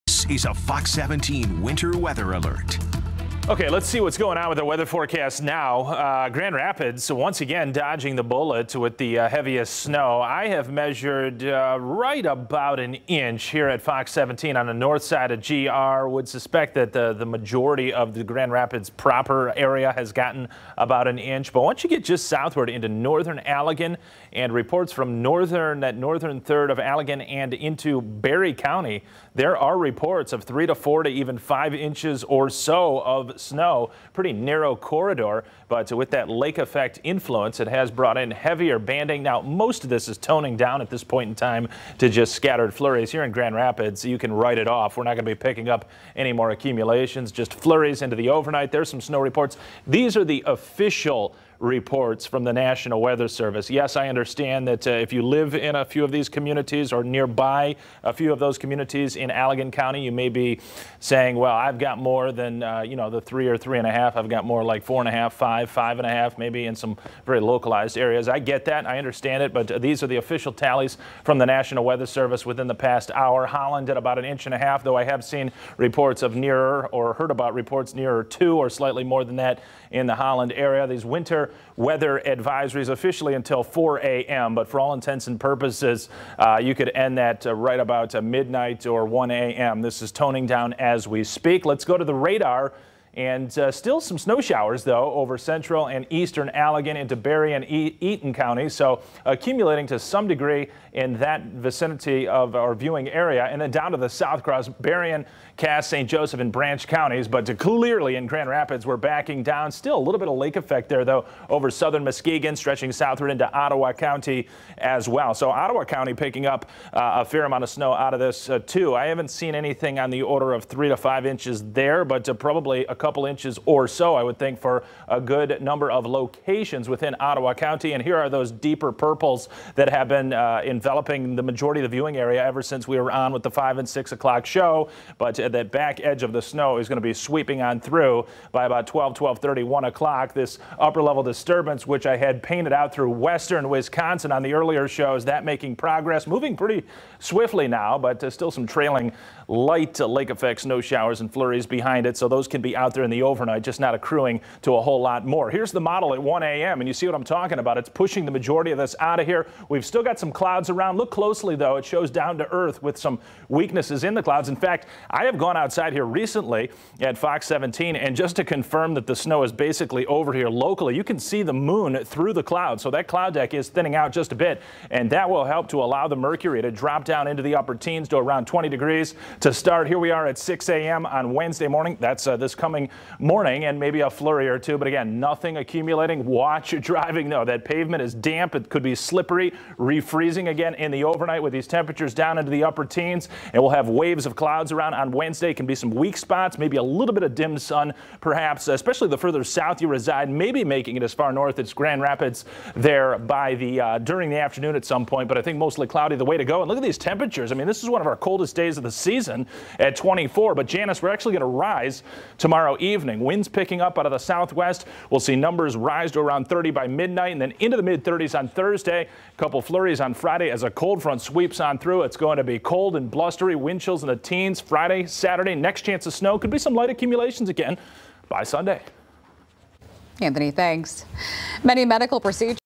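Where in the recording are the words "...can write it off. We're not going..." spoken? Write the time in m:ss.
0:44.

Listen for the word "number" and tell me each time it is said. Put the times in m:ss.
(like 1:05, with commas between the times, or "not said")
2:05, 3:35.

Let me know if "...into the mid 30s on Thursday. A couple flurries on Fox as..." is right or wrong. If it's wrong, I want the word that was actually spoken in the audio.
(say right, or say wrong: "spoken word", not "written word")
wrong: "Friday", not "Fox".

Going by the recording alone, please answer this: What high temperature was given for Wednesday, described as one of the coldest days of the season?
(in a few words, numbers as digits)
24.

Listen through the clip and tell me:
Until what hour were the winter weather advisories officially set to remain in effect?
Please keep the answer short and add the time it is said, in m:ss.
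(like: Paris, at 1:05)
4 a.m., at 1:23.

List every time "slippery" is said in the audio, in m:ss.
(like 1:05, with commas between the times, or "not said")
3:08.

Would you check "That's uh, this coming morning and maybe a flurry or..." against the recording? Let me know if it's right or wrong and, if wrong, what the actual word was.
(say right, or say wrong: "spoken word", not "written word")
right.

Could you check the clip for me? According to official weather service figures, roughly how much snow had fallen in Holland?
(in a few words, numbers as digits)
about an inch and a half.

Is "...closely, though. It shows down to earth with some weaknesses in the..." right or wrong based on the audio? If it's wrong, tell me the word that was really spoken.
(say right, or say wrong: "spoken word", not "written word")
right.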